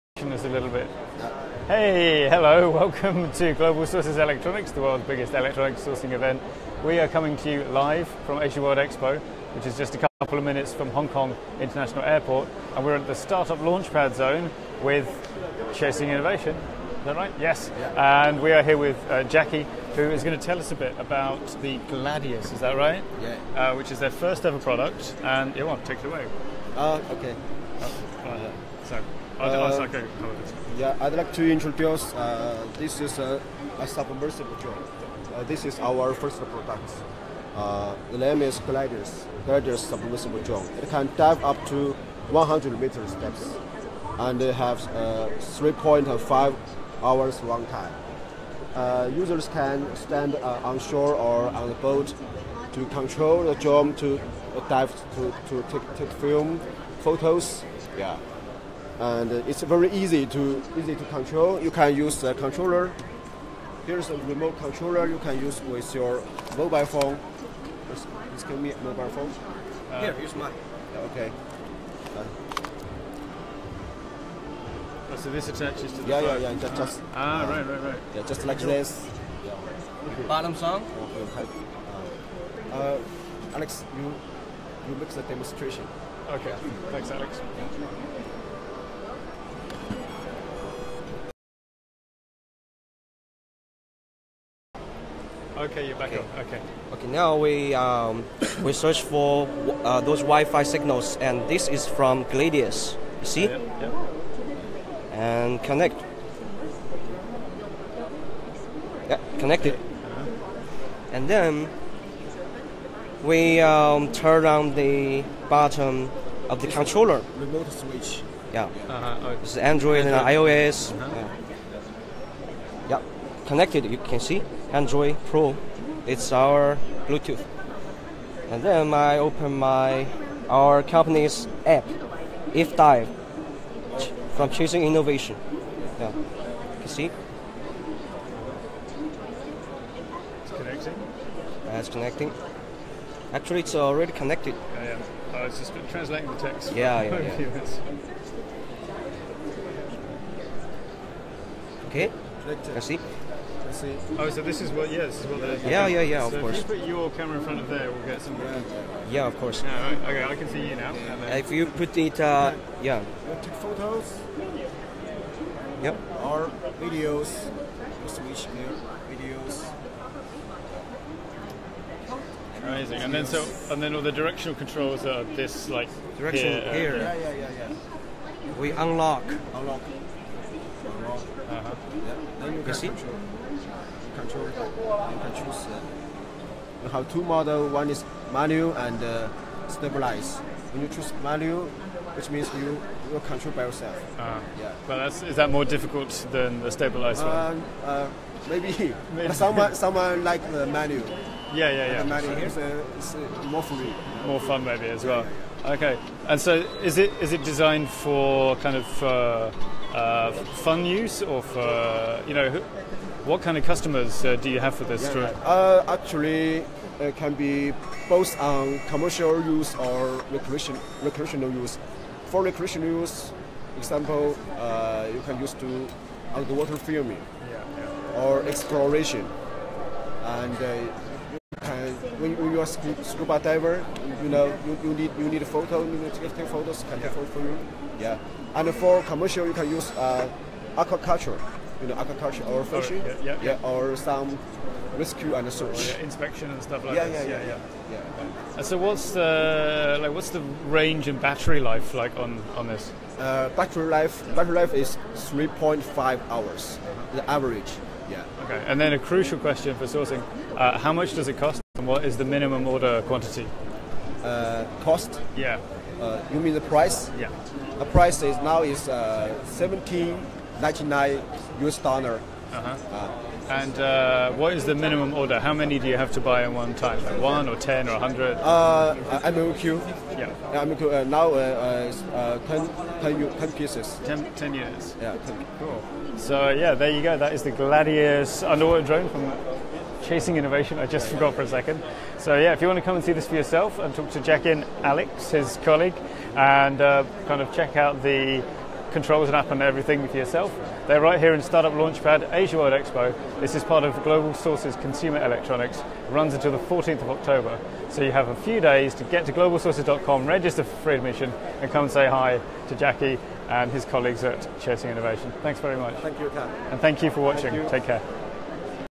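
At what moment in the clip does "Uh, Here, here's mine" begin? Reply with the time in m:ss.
1:09.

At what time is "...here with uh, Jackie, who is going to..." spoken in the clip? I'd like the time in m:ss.
0:18.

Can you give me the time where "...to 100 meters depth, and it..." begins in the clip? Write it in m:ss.
0:41.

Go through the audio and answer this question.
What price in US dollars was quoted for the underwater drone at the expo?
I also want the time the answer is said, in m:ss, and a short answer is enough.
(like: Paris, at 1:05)
17.99, at 4:29.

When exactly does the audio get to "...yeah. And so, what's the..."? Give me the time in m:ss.
4:07.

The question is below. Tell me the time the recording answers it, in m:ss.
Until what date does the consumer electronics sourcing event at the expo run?
5:06.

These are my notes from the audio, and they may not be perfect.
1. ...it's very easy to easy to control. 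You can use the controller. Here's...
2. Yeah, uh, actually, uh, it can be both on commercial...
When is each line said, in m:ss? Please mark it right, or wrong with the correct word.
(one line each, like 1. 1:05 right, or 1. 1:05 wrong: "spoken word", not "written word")
1. 0:59 right
2. 3:35 right.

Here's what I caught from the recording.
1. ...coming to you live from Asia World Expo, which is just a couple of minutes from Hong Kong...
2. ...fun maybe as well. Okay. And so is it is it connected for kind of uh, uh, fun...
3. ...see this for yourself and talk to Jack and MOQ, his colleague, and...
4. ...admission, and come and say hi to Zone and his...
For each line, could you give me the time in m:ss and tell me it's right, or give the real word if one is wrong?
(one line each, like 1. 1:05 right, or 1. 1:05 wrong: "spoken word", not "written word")
1. 0:07 right
2. 3:24 wrong: "designed", not "connected"
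3. 4:53 wrong: "Alex", not "MOQ"
4. 5:10 wrong: "Jackie", not "Zone".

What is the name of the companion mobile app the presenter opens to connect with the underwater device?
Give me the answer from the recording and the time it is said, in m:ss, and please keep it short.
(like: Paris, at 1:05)
If Dive, at 2:12.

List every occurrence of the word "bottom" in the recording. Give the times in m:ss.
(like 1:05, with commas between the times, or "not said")
1:20, 1:55.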